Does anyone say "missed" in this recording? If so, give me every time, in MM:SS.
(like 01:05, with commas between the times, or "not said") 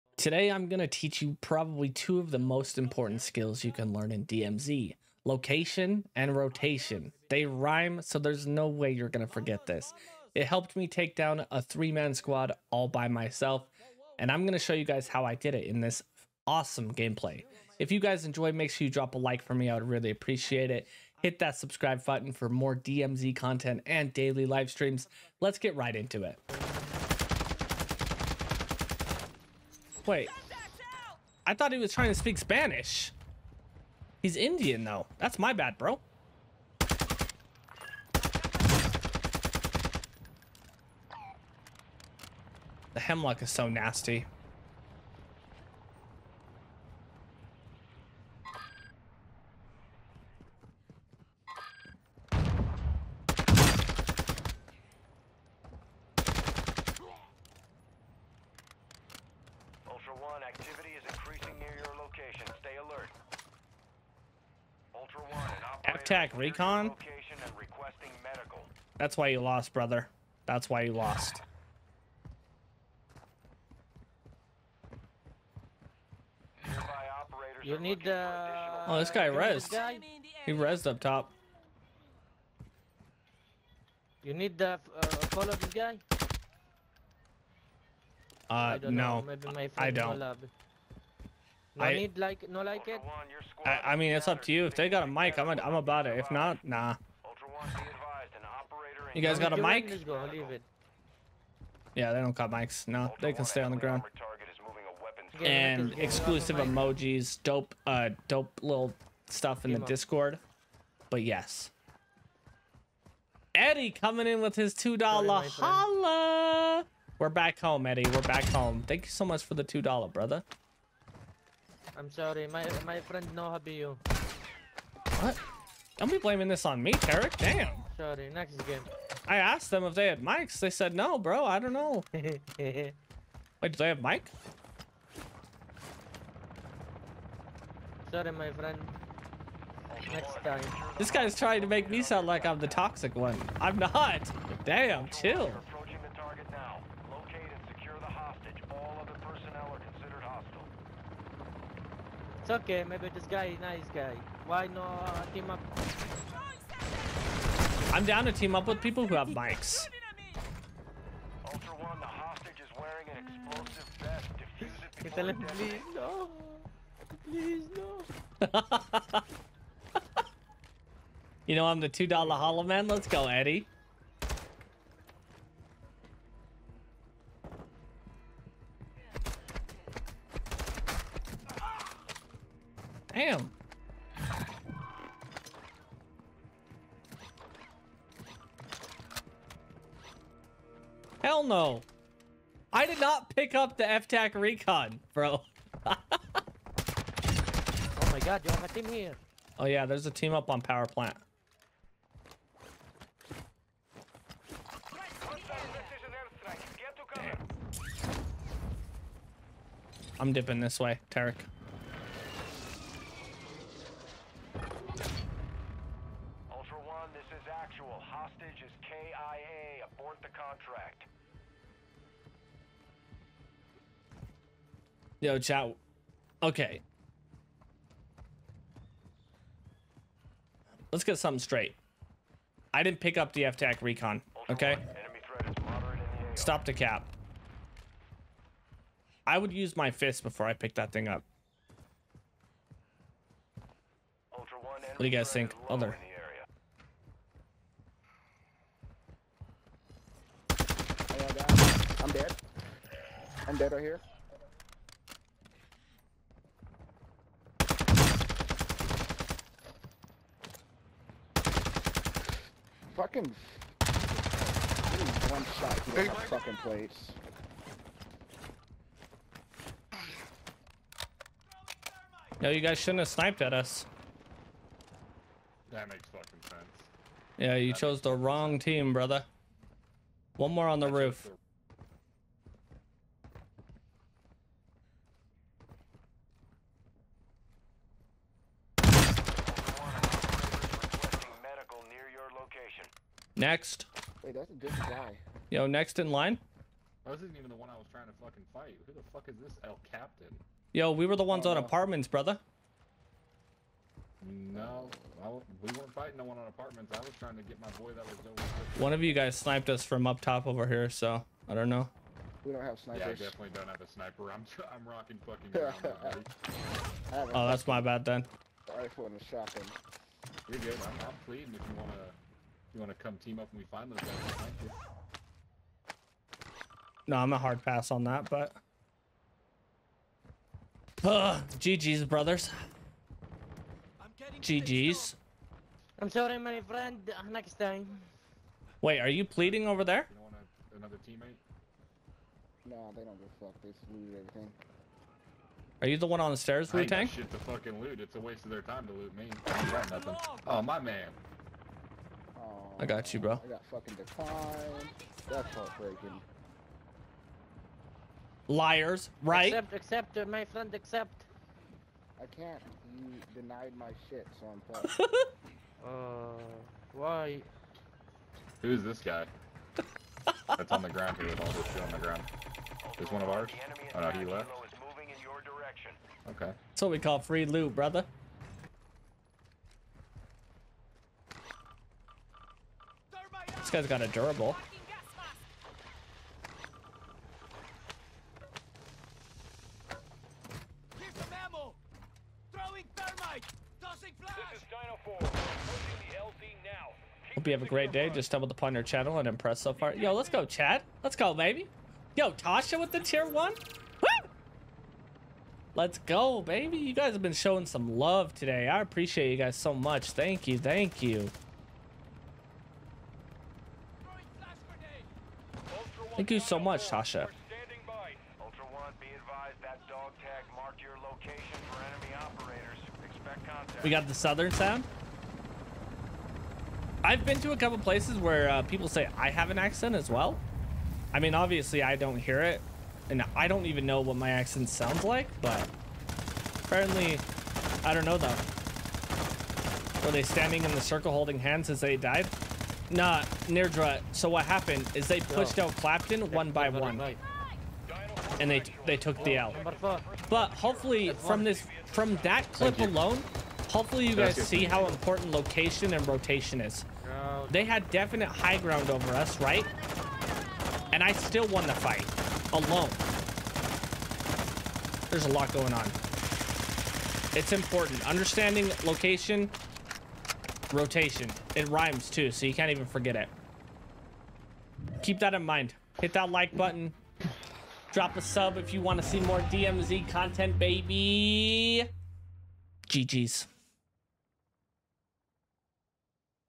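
not said.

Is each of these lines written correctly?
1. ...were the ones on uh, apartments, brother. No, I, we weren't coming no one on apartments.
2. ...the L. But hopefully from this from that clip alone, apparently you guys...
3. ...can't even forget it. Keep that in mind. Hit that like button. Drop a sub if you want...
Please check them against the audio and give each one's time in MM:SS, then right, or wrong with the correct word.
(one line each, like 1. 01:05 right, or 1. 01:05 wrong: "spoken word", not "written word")
1. 05:01 wrong: "fighting", not "coming"
2. 07:29 wrong: "hopefully", not "apparently"
3. 07:52 right.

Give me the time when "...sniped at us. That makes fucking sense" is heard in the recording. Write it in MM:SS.
04:33.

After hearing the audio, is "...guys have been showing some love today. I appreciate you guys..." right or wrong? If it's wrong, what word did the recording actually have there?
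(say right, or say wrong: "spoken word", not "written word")
right.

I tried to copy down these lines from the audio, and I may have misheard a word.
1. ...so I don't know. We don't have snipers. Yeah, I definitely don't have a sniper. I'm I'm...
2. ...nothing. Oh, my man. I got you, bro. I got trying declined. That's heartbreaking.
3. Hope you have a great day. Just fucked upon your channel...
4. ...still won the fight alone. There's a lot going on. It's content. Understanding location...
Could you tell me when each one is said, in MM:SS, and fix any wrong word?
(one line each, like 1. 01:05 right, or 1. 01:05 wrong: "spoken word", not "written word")
1. 05:10 right
2. 05:49 wrong: "fucking", not "trying"
3. 06:37 wrong: "stumbled", not "fucked"
4. 07:41 wrong: "important", not "content".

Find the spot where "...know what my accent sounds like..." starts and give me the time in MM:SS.
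07:13.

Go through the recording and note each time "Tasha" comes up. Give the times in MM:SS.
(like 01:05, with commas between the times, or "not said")
06:42, 06:56.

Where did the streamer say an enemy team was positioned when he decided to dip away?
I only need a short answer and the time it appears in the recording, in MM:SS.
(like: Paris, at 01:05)
Power plant, at 03:20.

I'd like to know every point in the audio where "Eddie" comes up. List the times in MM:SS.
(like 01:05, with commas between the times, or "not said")
01:53, 01:57, 02:53.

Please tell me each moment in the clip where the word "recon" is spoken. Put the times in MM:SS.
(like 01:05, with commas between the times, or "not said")
01:06, 03:14, 03:53.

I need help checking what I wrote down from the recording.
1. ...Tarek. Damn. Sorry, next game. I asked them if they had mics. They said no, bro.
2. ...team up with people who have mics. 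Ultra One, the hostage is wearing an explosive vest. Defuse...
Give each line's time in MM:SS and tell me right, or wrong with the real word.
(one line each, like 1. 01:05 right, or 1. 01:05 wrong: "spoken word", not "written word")
1. 02:06 right
2. 02:38 right.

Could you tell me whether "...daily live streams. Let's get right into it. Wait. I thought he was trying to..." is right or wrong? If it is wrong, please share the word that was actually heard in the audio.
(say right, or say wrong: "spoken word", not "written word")
right.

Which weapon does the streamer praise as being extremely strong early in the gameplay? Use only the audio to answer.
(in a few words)
Hemlock.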